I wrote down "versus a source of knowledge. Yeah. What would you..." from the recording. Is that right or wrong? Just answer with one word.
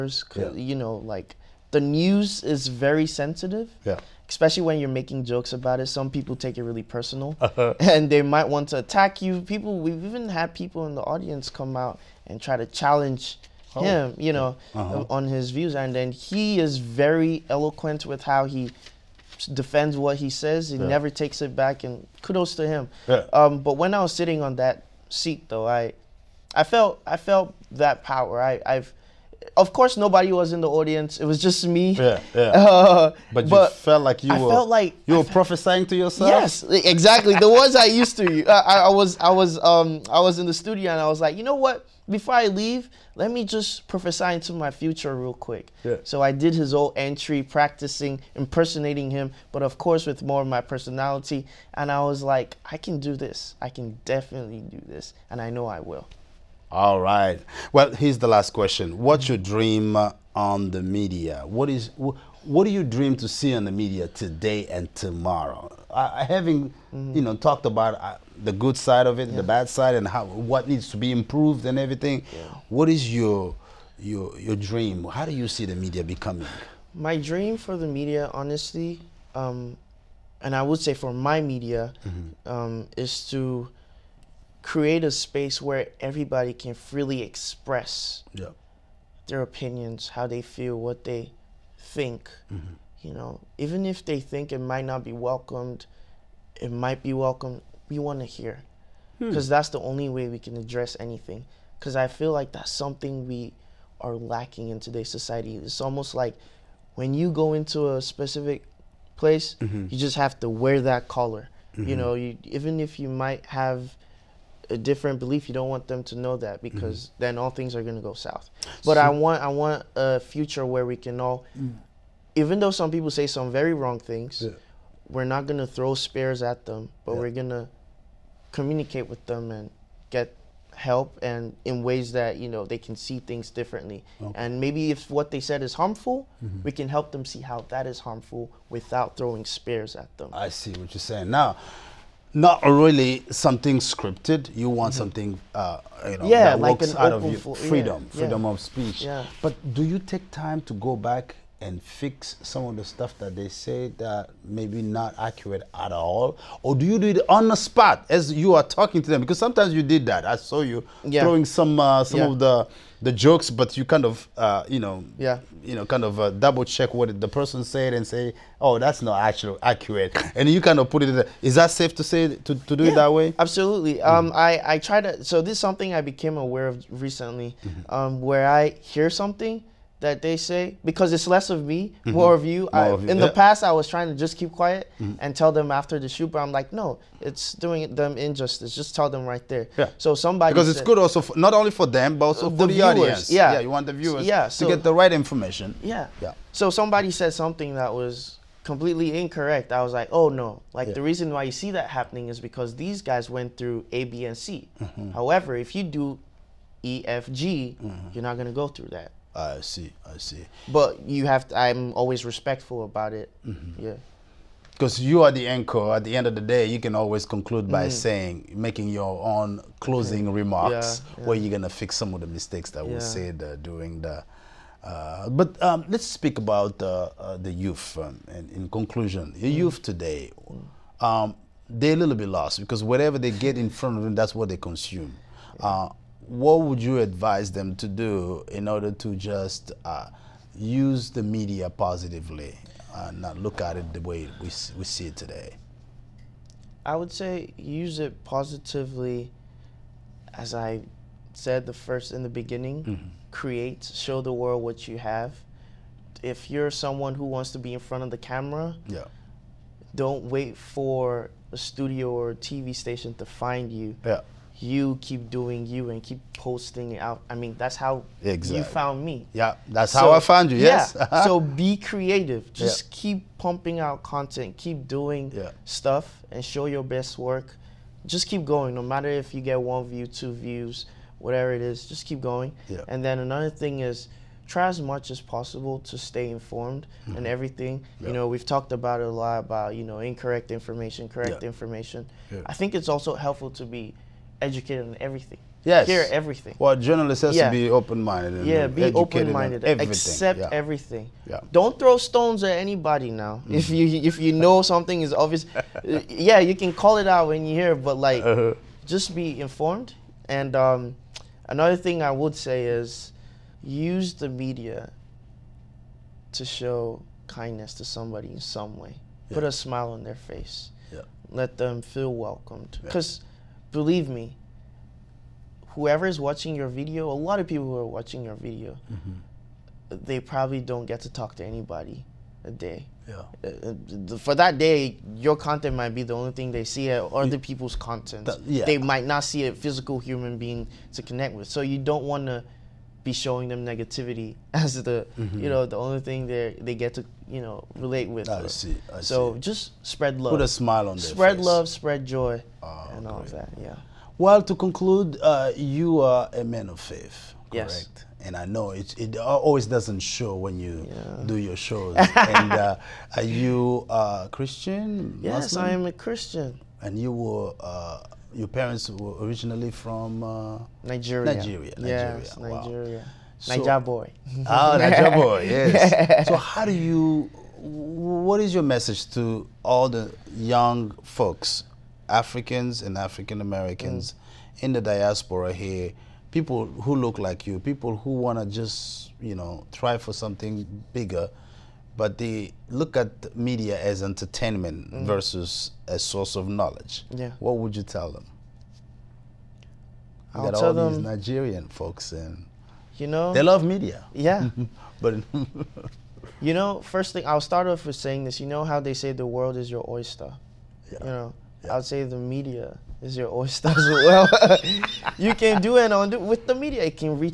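right.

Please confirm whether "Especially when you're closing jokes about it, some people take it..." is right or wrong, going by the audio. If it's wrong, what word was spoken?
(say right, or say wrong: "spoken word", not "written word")
wrong: "making", not "closing".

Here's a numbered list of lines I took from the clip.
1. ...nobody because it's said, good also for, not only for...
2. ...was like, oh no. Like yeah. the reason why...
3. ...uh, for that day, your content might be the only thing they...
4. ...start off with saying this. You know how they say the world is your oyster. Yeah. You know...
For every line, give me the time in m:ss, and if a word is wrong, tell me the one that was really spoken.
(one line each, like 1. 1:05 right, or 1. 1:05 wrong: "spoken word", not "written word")
1. 3:10 wrong: "somebody", not "nobody"
2. 3:19 right
3. 5:34 right
4. 6:47 right.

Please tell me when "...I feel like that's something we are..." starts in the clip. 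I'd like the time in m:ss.
1:41.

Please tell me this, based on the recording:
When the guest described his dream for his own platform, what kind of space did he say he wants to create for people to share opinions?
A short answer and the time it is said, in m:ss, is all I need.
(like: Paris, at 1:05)
a space where everybody can freely express, at 1:24.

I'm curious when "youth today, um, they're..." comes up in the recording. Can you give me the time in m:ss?
3:49.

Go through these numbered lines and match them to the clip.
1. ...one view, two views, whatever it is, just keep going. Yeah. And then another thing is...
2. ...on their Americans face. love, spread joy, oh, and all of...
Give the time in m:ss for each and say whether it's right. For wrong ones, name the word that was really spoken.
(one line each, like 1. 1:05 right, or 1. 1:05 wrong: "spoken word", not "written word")
1. 4:39 right
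2. 5:50 wrong: "Spread", not "Americans".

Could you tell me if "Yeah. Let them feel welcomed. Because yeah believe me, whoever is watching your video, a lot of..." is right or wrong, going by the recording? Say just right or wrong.
right.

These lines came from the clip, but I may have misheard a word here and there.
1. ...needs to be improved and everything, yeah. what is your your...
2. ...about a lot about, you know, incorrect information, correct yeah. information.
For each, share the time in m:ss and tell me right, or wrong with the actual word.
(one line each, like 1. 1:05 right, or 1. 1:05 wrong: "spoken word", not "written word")
1. 1:10 right
2. 4:48 right.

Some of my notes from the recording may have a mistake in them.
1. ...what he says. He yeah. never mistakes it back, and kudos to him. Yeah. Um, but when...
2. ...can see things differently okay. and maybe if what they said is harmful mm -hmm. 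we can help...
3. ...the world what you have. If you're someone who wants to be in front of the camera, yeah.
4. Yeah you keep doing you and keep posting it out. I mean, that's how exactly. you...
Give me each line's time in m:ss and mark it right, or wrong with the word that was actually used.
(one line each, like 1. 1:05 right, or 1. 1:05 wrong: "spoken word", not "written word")
1. 0:19 wrong: "takes", not "mistakes"
2. 2:12 right
3. 4:14 right
4. 4:24 right.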